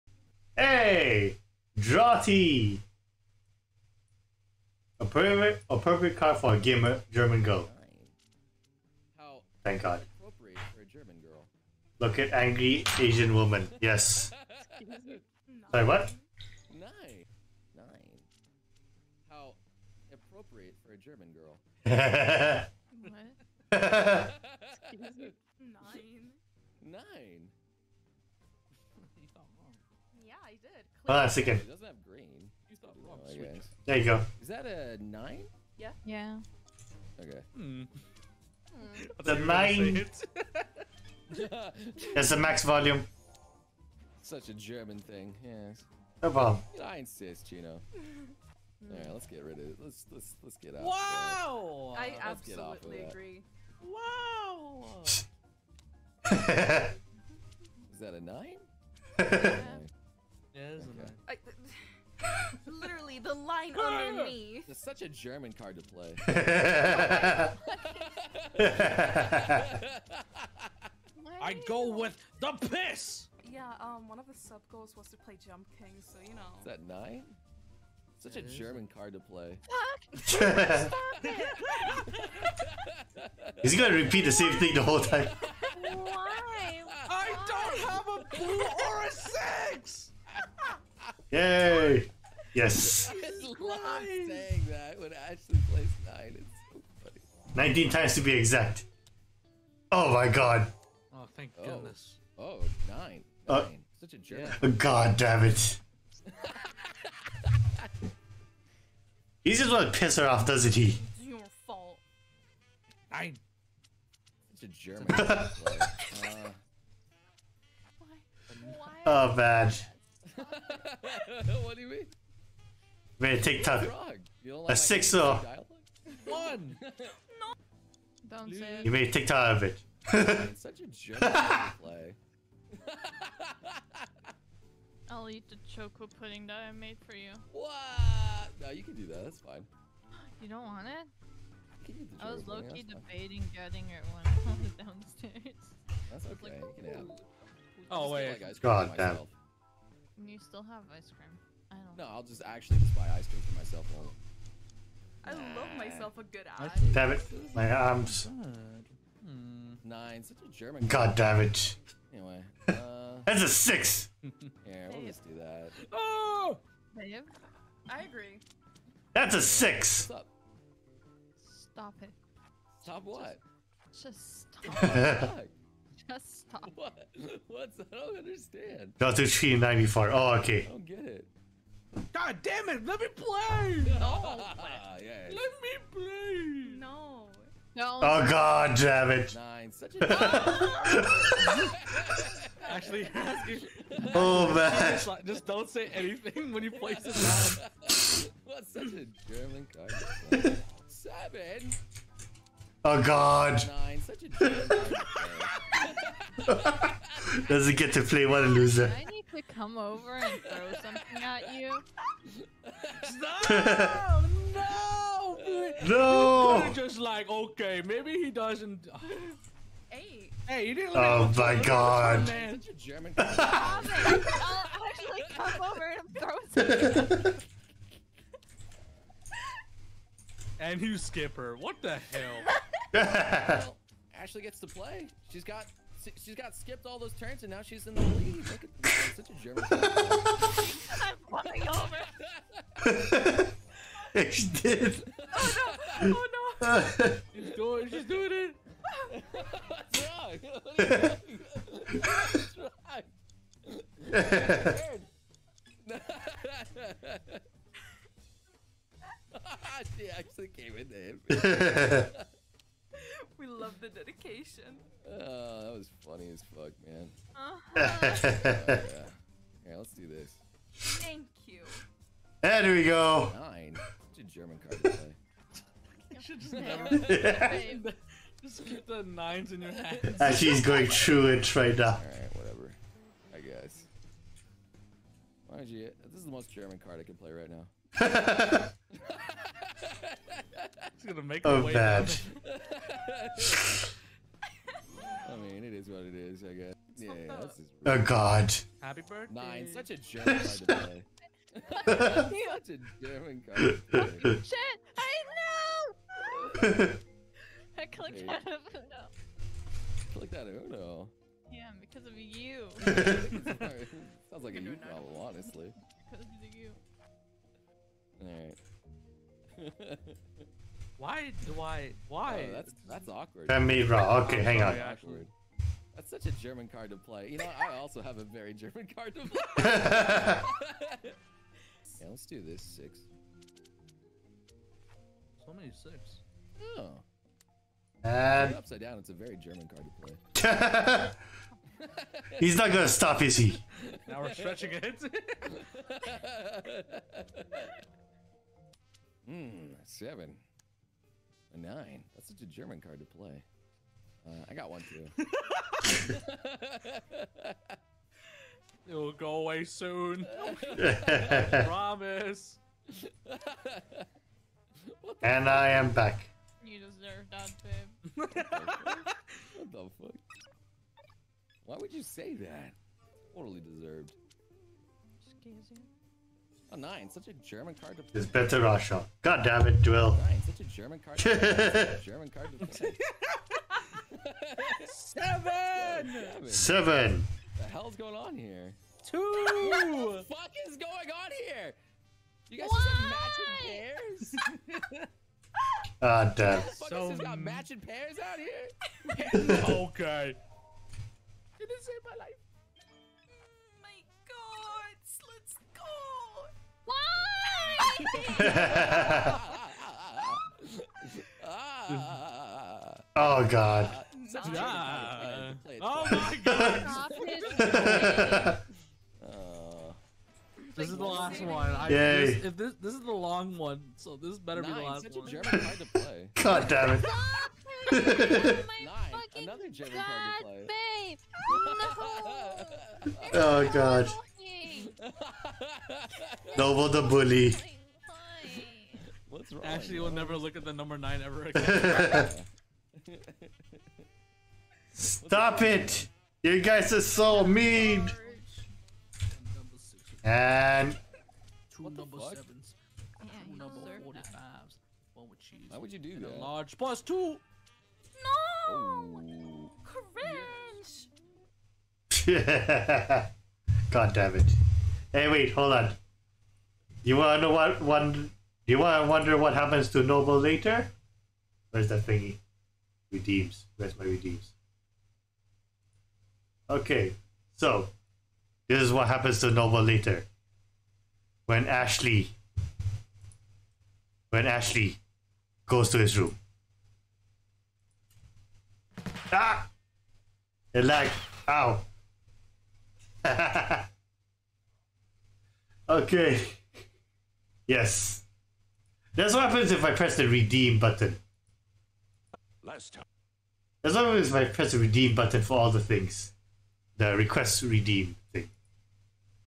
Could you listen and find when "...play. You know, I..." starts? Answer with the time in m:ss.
5:26.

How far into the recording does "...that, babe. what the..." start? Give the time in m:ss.
6:07.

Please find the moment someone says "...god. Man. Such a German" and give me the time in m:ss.
3:41.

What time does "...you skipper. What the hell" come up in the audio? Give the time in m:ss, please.
3:50.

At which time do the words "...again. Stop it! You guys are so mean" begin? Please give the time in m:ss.
7:21.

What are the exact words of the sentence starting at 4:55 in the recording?
I mean, it is what it is, I guess yeah, Oh God.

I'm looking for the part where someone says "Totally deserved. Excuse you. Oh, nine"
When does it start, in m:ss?
6:13.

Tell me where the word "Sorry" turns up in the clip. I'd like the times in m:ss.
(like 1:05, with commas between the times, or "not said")
0:15.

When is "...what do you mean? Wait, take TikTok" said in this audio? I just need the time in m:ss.
2:01.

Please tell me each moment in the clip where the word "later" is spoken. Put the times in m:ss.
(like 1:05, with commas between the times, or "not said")
7:50, 7:59.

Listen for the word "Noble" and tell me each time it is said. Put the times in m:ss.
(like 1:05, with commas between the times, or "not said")
7:16, 7:50, 7:59.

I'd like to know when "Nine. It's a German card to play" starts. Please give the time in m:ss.
4:33.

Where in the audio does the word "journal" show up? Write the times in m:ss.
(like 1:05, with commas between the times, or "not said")
not said.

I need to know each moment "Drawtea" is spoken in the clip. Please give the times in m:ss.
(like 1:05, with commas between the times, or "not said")
0:01.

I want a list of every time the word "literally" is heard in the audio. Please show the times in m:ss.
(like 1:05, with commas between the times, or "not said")
1:02.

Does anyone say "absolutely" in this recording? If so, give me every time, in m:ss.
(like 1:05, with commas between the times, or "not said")
0:52.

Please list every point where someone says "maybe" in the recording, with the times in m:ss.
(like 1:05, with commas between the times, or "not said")
3:37.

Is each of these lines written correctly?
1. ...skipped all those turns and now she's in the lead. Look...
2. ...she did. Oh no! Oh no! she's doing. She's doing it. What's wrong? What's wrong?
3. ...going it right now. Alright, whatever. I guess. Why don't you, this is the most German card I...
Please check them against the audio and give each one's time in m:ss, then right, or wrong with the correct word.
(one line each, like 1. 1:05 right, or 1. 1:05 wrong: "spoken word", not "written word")
1. 3:56 right
2. 4:04 right
3. 4:40 right.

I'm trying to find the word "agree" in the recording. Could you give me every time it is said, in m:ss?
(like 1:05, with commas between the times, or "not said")
0:53, 2:48.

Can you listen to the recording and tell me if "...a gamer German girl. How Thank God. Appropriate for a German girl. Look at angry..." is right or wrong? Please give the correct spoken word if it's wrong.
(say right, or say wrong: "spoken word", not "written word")
right.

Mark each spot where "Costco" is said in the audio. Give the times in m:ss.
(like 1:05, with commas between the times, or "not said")
not said.